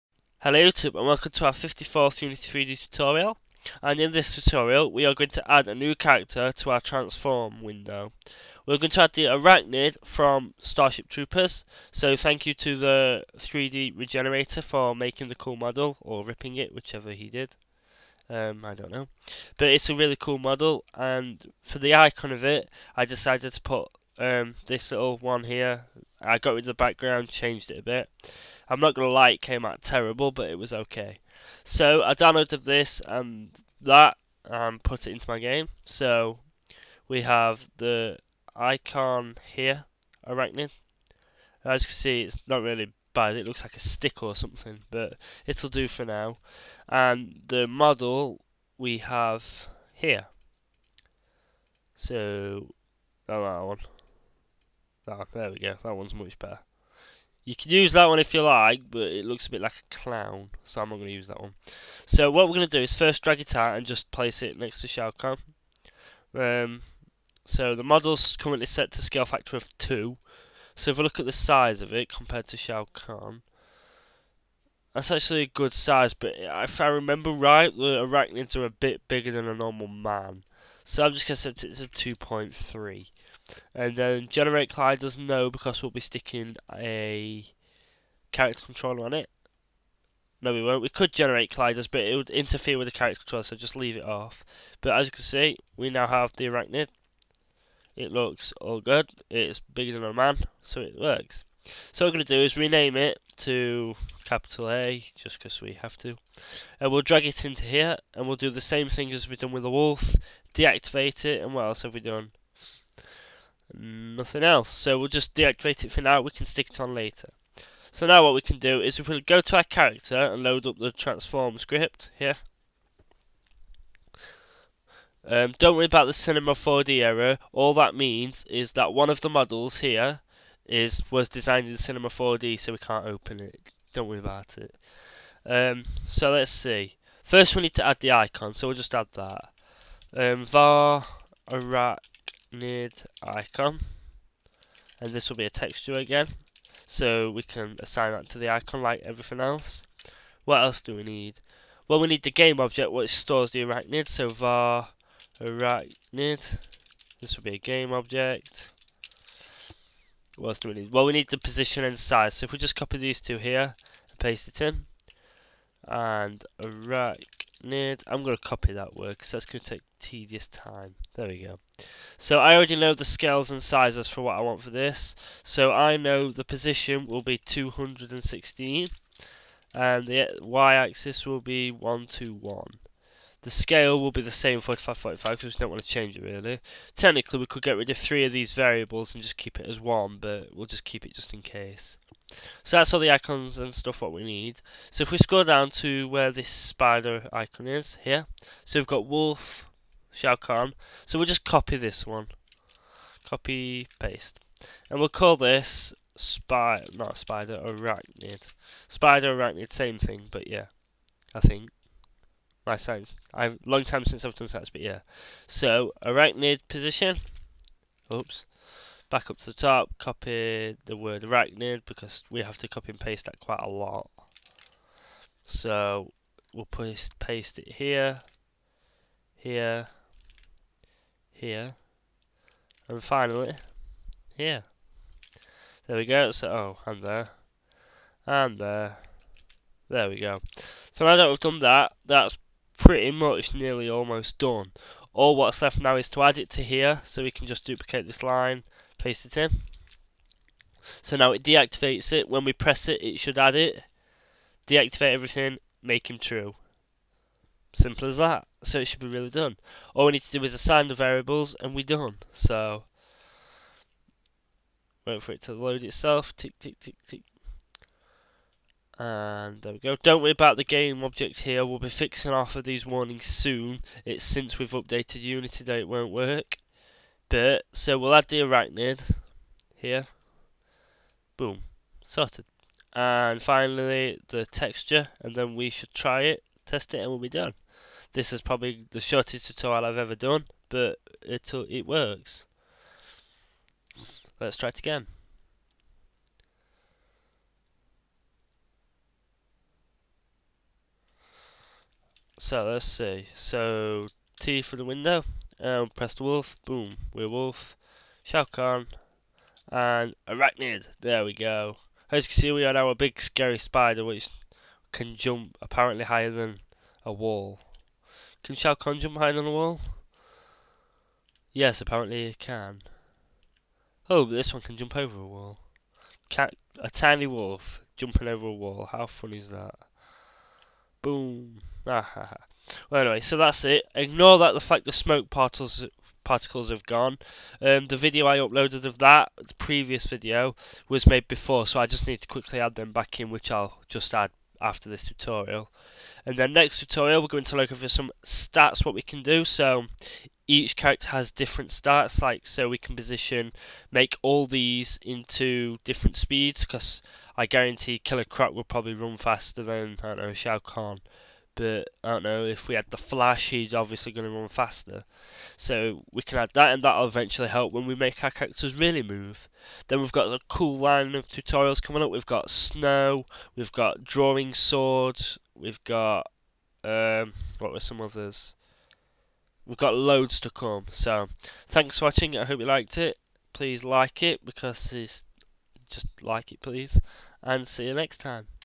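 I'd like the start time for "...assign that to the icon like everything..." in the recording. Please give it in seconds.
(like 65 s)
147 s.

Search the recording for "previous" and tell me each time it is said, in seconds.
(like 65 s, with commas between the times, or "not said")
339 s.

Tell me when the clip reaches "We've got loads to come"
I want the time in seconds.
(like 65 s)
379 s.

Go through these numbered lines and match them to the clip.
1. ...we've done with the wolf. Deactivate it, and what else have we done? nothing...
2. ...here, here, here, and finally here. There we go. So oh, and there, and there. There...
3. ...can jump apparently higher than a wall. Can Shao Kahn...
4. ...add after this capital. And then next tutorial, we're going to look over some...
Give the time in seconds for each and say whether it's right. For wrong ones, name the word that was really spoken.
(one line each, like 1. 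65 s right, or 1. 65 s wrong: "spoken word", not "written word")
1. 109 s right
2. 227 s right
3. 314 s right
4. 344 s wrong: "tutorial", not "capital".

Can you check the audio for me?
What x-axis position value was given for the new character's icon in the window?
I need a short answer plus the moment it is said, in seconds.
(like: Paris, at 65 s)
216, at 177 s.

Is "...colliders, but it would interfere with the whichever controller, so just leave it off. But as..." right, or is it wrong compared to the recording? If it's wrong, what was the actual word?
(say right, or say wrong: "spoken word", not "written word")
wrong: "character", not "whichever".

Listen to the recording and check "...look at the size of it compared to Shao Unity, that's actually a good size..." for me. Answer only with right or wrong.
wrong.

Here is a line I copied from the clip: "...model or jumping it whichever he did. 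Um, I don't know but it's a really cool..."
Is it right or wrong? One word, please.
wrong.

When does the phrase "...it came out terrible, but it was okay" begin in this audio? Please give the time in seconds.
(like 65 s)
29 s.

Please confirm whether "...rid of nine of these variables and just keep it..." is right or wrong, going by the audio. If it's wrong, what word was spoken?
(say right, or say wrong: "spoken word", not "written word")
wrong: "three", not "nine".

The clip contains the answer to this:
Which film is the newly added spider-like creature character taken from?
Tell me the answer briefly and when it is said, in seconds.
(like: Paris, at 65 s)
Starship Troopers, at 10 s.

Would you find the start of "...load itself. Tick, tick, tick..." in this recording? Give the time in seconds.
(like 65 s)
265 s.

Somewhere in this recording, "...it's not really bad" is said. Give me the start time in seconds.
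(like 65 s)
42 s.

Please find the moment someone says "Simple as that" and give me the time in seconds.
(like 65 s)
257 s.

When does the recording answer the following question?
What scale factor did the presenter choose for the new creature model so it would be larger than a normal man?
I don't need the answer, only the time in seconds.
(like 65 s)
82 s.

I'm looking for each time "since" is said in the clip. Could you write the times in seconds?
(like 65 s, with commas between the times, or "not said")
214 s, 274 s.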